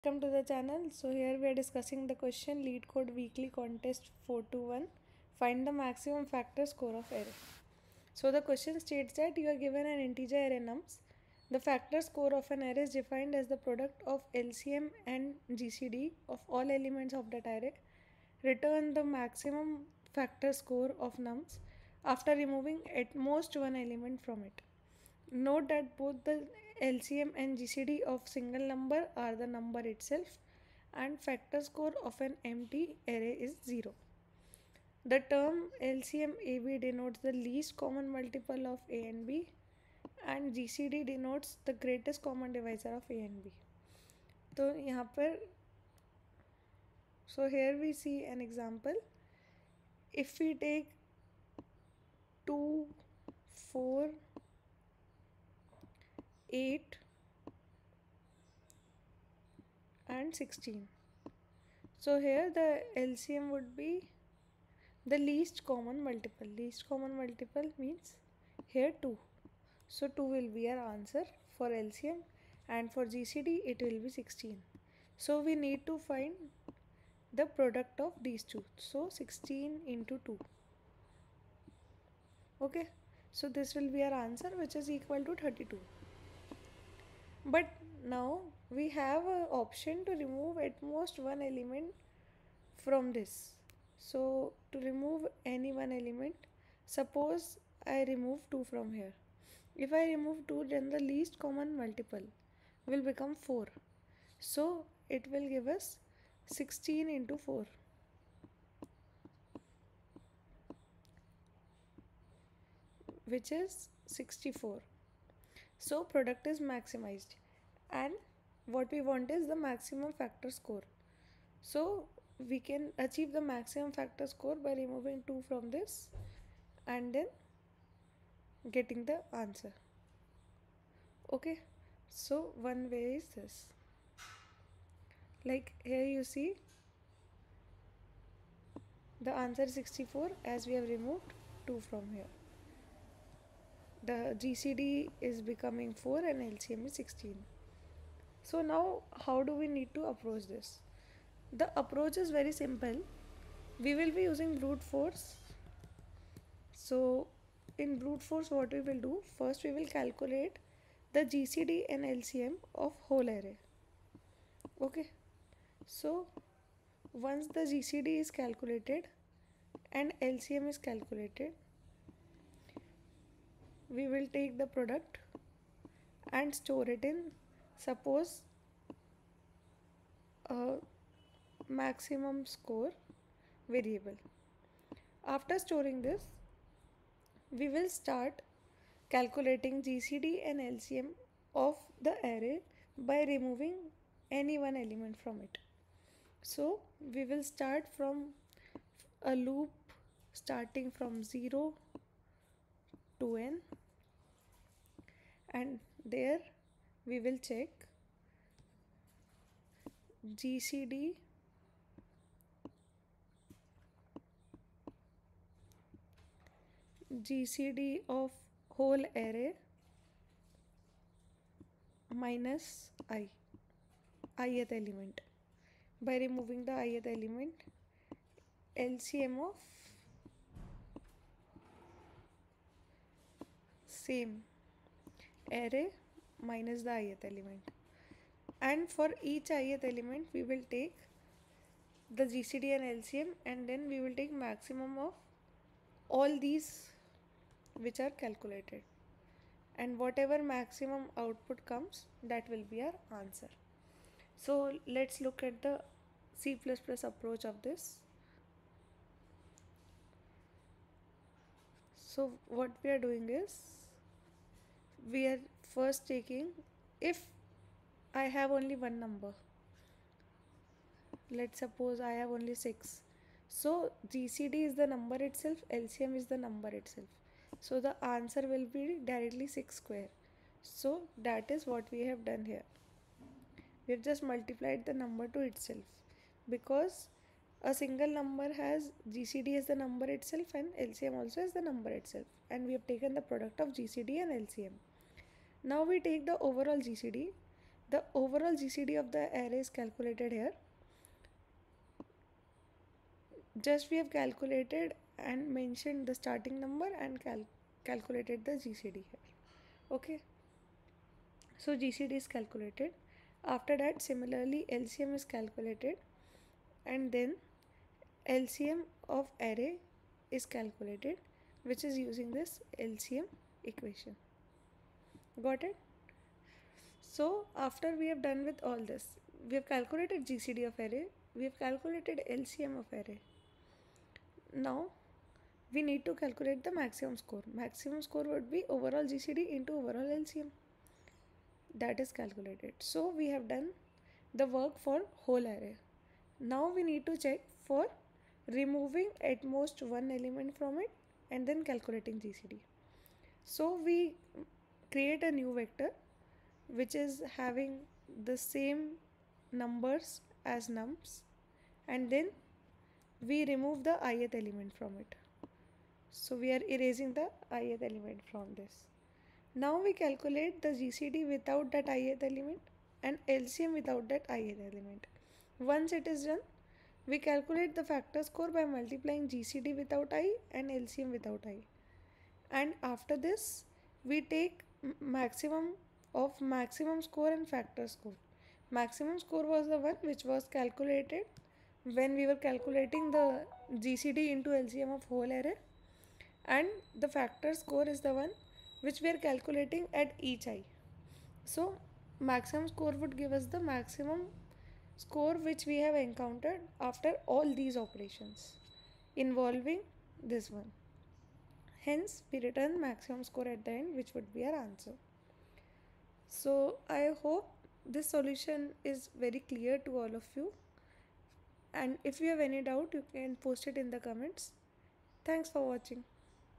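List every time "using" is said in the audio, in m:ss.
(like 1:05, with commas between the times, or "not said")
2:34, 5:21.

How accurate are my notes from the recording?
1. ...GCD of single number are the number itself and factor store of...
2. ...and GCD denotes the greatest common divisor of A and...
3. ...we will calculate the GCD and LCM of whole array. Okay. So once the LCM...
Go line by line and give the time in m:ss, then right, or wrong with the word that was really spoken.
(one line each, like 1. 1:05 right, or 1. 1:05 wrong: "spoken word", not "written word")
1. 0:27 wrong: "score", not "store"
2. 0:40 right
3. 2:39 wrong: "GCD", not "LCM".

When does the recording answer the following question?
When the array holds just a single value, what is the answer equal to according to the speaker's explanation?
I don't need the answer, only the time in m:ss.
4:39.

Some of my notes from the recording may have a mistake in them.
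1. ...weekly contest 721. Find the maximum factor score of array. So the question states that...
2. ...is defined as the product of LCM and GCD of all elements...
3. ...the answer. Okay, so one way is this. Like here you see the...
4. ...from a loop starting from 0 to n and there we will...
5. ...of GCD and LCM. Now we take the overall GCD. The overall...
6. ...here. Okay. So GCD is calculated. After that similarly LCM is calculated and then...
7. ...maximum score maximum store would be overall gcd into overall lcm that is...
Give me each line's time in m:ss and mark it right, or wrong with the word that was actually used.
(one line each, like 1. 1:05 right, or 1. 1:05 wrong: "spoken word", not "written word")
1. 0:03 wrong: "421", not "721"
2. 0:12 right
3. 2:09 right
4. 3:17 right
5. 4:53 right
6. 5:09 right
7. 5:36 wrong: "score", not "store".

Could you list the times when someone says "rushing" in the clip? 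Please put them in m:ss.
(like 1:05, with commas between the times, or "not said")
not said.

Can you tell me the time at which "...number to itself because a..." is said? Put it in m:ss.
4:44.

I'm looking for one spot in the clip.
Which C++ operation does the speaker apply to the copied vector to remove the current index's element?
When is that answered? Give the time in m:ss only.
6:06.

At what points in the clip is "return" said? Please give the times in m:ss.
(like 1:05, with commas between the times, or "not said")
0:18, 6:52.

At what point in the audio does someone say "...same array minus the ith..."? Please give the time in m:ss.
3:53.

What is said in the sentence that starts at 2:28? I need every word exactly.
So now how do we need to approach this?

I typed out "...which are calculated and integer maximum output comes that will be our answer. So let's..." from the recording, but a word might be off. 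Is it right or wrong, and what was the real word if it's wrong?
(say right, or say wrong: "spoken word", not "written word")
wrong: "whatever", not "integer".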